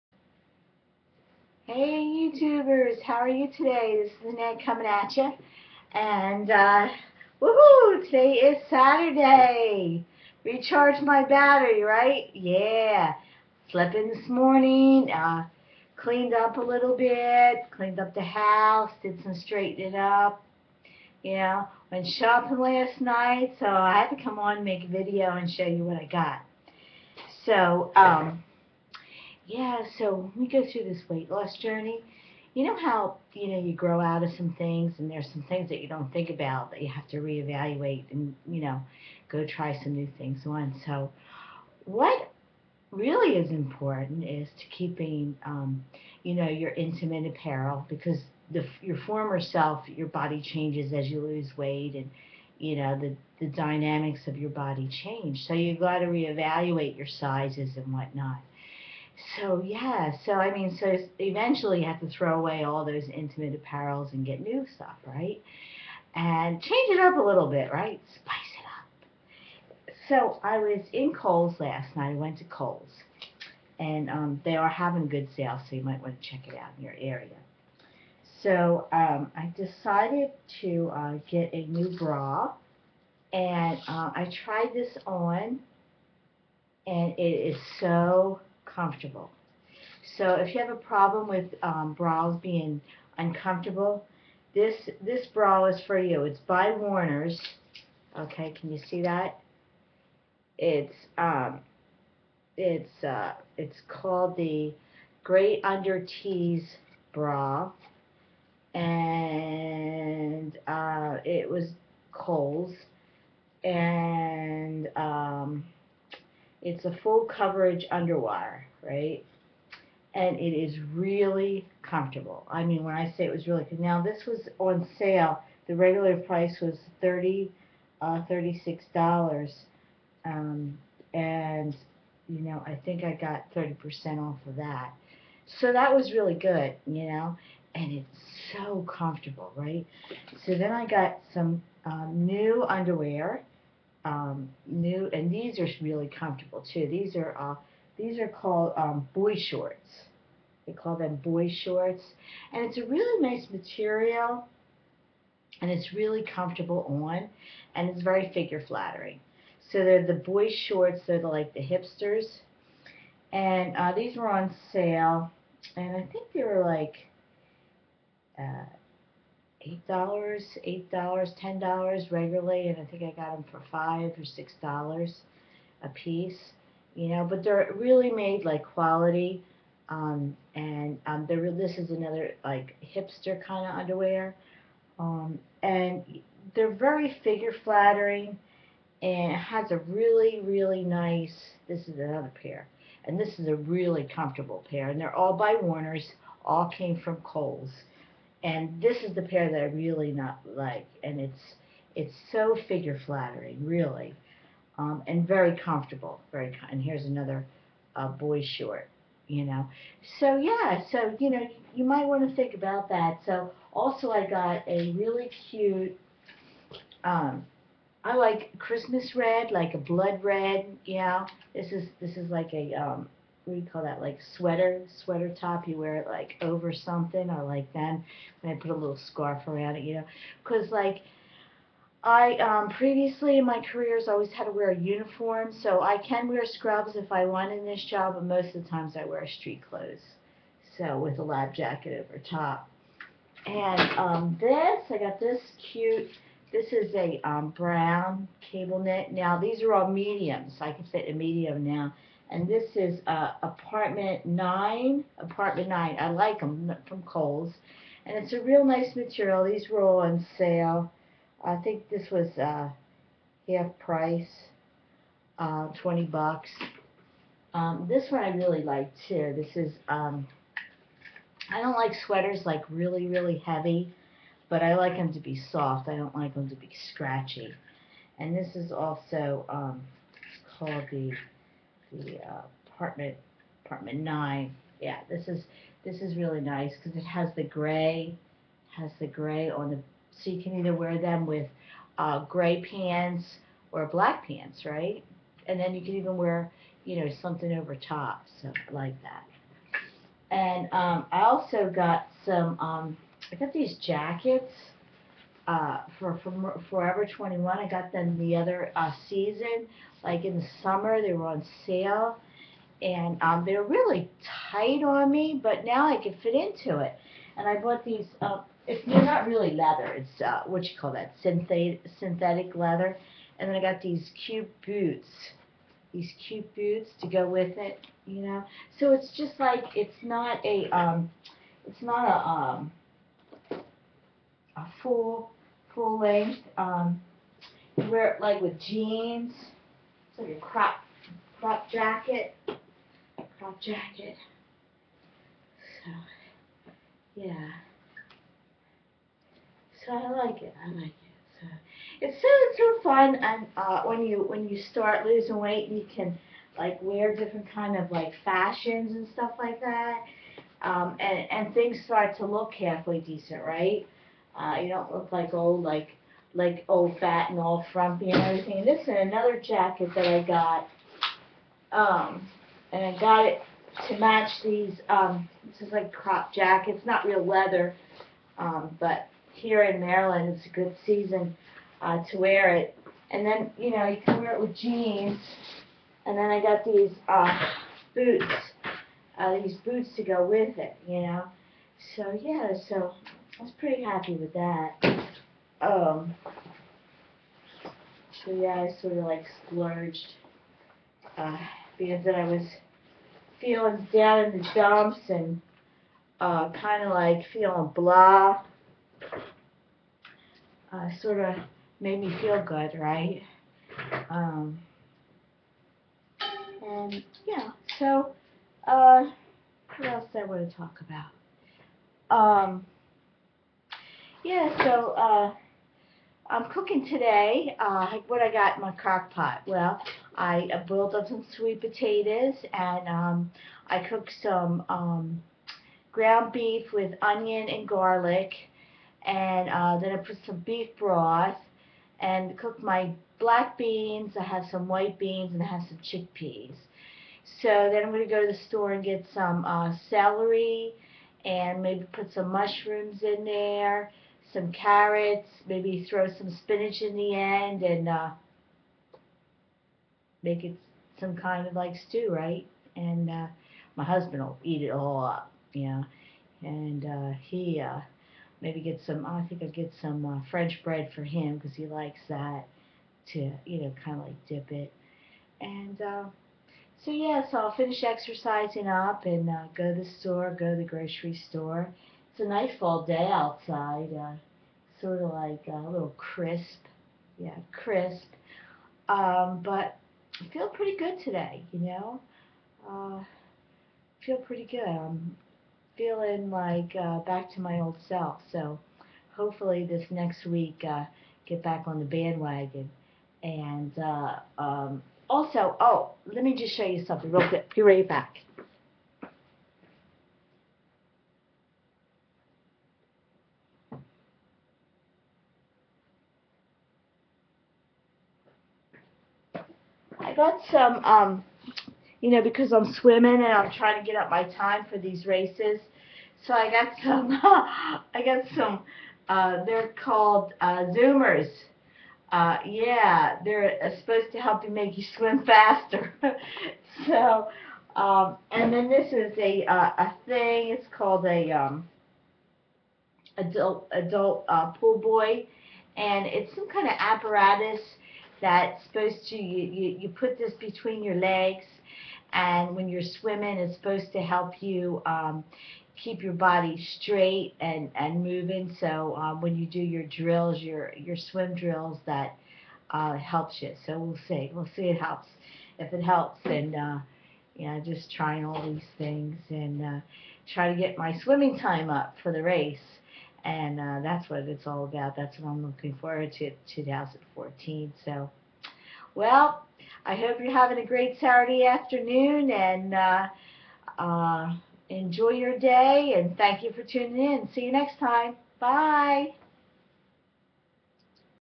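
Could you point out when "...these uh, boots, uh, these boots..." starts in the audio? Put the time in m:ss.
6:26.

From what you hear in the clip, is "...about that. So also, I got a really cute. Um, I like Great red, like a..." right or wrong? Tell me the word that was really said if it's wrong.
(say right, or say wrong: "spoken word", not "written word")
wrong: "Christmas", not "Great".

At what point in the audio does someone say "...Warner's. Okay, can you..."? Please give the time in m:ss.
1:36.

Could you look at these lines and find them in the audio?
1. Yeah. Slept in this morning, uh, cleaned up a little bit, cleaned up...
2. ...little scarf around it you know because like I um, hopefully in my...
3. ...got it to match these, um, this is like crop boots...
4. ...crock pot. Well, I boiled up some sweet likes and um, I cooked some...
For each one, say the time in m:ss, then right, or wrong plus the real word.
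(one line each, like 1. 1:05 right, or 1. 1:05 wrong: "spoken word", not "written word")
1. 0:12 right
2. 3:48 wrong: "previously", not "hopefully"
3. 6:12 wrong: "jackets", not "boots"
4. 7:08 wrong: "potatoes", not "likes".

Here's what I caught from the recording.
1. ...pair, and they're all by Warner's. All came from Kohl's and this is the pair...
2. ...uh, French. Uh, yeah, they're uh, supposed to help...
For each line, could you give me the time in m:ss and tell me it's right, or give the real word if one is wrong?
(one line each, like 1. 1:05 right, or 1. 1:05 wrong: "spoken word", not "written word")
1. 3:14 right
2. 8:50 wrong: "Zoomers", not "French".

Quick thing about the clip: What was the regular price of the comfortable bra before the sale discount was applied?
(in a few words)
$36.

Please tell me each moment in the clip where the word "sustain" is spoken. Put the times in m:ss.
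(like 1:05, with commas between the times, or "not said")
not said.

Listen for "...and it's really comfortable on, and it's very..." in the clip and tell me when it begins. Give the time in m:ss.
2:35.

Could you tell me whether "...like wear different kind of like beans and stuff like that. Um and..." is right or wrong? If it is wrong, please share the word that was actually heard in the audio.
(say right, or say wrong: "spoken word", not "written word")
wrong: "fashions", not "beans".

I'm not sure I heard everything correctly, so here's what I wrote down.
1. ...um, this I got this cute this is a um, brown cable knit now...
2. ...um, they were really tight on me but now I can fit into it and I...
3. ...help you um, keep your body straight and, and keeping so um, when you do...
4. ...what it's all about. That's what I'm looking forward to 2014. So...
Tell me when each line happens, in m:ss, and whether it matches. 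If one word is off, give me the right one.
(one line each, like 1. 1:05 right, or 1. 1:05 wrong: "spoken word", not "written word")
1. 4:03 right
2. 5:13 right
3. 9:13 wrong: "moving", not "keeping"
4. 9:34 right.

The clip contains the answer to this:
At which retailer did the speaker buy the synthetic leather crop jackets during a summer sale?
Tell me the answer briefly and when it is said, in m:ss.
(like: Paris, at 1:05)
Forever 21, at 5:06.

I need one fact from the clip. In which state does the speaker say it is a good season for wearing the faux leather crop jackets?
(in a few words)
Maryland.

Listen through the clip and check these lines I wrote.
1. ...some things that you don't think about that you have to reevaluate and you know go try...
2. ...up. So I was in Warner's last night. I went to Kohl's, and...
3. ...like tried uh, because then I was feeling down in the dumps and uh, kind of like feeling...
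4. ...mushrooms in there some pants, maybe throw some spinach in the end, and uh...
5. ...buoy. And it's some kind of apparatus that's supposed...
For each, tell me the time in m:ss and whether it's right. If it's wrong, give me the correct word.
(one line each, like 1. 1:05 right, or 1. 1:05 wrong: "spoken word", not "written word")
1. 0:35 right
2. 1:09 wrong: "Kohl", not "Warner"
3. 6:39 wrong: "splurged", not "tried"
4. 7:32 wrong: "carrots", not "pants"
5. 9:04 right.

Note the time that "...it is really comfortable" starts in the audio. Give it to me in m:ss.
2:00.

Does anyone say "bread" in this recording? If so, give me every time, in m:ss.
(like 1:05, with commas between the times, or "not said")
7:50.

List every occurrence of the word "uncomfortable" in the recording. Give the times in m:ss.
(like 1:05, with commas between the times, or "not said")
1:33.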